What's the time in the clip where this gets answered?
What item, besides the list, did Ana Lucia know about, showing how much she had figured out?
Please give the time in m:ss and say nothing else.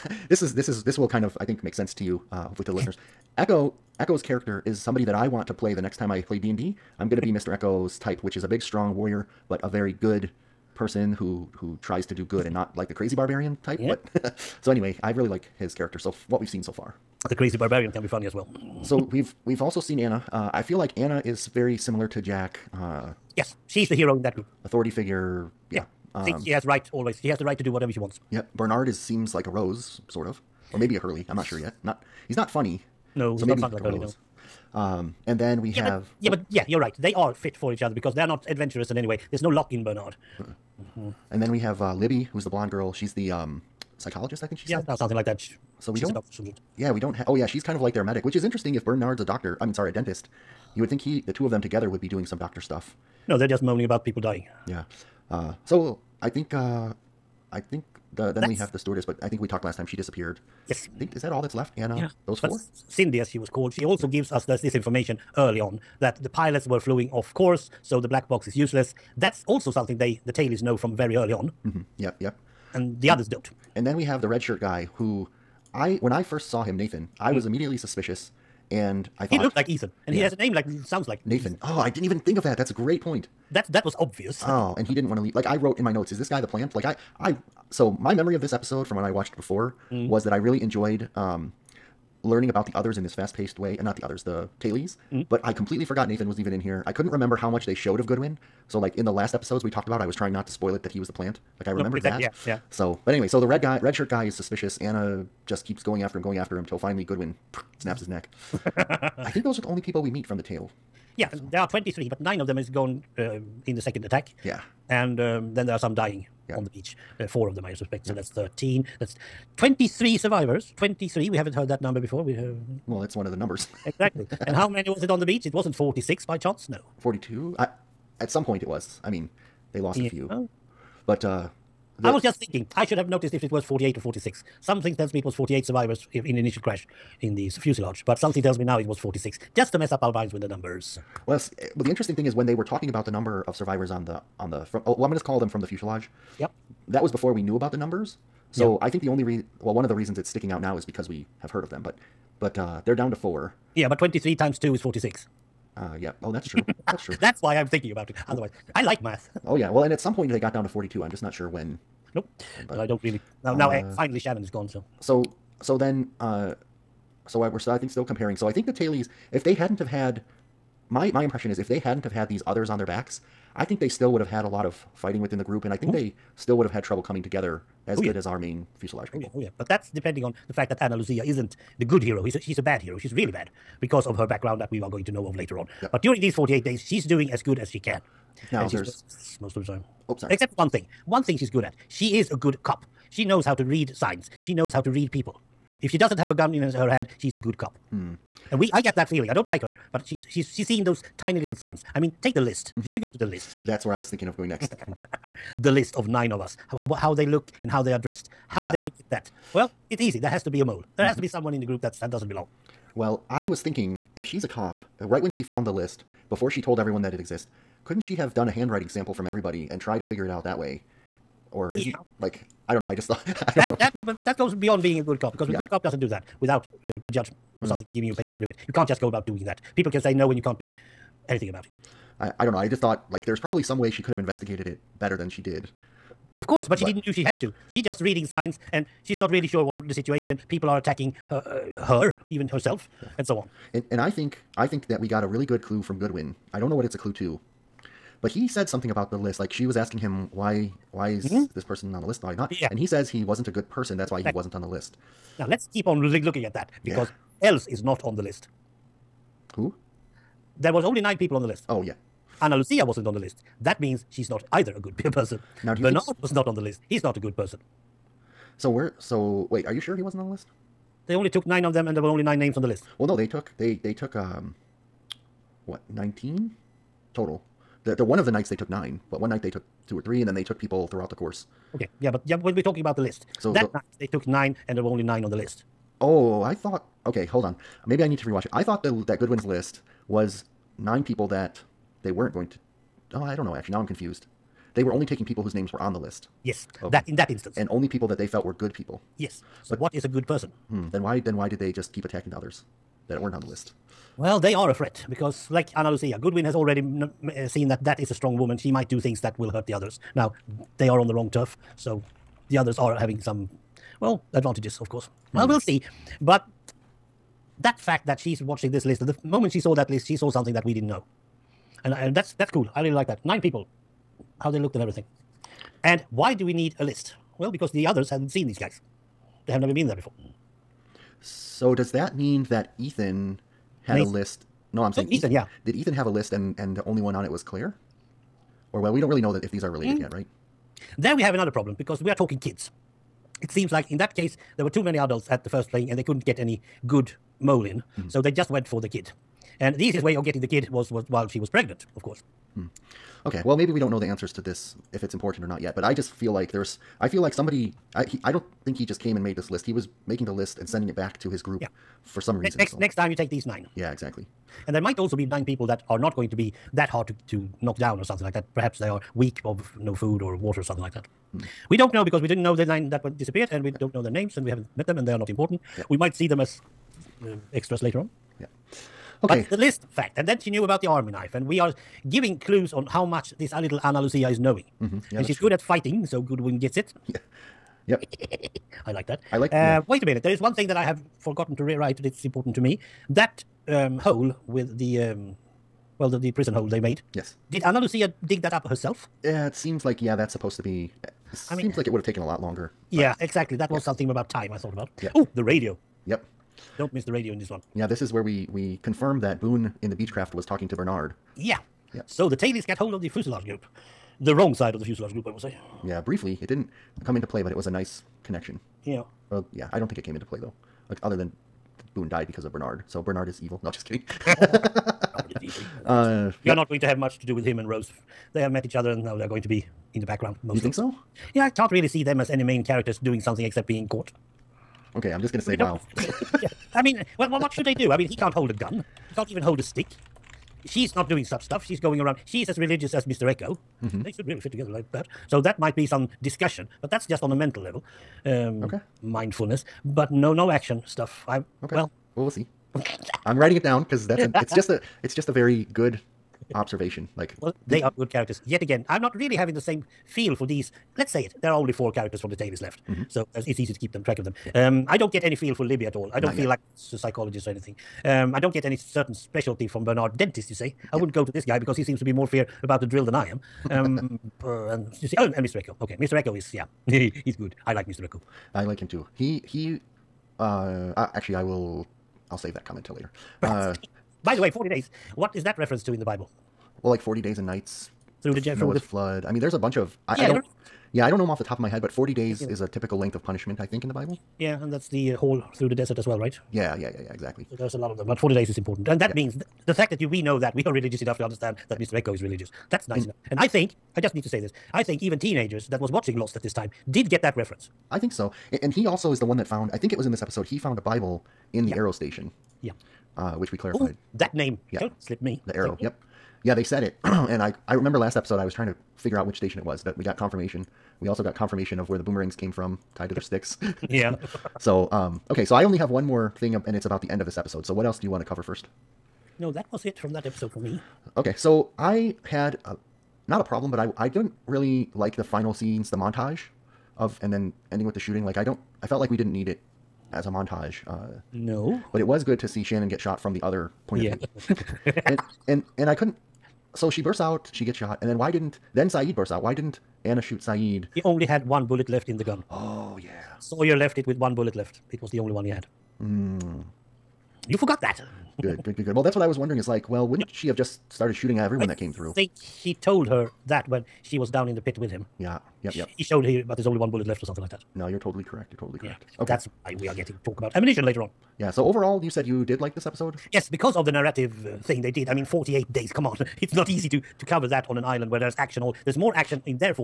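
6:20.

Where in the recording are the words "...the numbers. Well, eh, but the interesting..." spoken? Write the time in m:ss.
2:20.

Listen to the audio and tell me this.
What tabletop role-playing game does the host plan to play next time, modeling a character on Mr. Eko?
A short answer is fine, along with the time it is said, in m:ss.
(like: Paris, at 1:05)
D and D, at 0:06.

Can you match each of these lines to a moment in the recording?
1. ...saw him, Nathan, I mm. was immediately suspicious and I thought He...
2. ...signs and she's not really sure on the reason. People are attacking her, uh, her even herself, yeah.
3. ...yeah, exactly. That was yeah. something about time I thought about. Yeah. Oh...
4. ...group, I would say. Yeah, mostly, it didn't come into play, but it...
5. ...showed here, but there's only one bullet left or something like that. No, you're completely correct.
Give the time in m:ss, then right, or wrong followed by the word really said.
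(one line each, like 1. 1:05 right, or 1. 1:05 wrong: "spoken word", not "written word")
1. 1:16 right
2. 3:58 wrong: "situation", not "reason"
3. 6:42 right
4. 6:55 wrong: "briefly", not "mostly"
5. 9:26 wrong: "totally", not "completely".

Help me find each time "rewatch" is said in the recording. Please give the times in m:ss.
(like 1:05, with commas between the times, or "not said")
4:48.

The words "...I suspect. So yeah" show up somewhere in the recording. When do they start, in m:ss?
1:57.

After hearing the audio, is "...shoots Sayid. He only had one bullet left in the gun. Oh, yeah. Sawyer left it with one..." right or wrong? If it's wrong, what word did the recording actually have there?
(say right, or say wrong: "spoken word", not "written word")
right.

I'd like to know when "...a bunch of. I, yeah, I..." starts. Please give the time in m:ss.
8:09.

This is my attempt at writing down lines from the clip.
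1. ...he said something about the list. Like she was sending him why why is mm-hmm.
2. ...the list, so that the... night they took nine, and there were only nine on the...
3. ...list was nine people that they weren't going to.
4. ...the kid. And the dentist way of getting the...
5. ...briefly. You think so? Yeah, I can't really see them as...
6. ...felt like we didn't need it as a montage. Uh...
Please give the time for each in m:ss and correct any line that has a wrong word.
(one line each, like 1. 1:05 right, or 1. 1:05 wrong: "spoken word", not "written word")
1. 4:08 wrong: "asking", not "sending"
2. 4:42 right
3. 4:49 right
4. 5:48 wrong: "easiest", not "dentist"
5. 7:10 wrong: "mostly", not "briefly"
6. 8:58 right.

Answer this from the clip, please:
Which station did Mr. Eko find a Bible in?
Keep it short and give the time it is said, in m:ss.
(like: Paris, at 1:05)
Arrow Station, at 8:31.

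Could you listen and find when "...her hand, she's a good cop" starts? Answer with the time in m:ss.
3:16.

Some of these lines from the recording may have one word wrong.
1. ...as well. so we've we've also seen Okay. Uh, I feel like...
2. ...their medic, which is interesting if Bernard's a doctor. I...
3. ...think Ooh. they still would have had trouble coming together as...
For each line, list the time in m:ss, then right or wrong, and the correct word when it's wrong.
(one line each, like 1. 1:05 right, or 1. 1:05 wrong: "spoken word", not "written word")
1. 0:18 wrong: "Ana", not "Okay"
2. 0:47 right
3. 2:55 right.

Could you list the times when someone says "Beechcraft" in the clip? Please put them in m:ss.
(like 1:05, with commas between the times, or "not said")
6:49.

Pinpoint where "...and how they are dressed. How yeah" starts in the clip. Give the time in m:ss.
3:27.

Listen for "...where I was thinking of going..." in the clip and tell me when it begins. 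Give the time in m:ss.
3:23.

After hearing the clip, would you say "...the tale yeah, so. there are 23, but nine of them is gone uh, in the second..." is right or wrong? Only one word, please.
right.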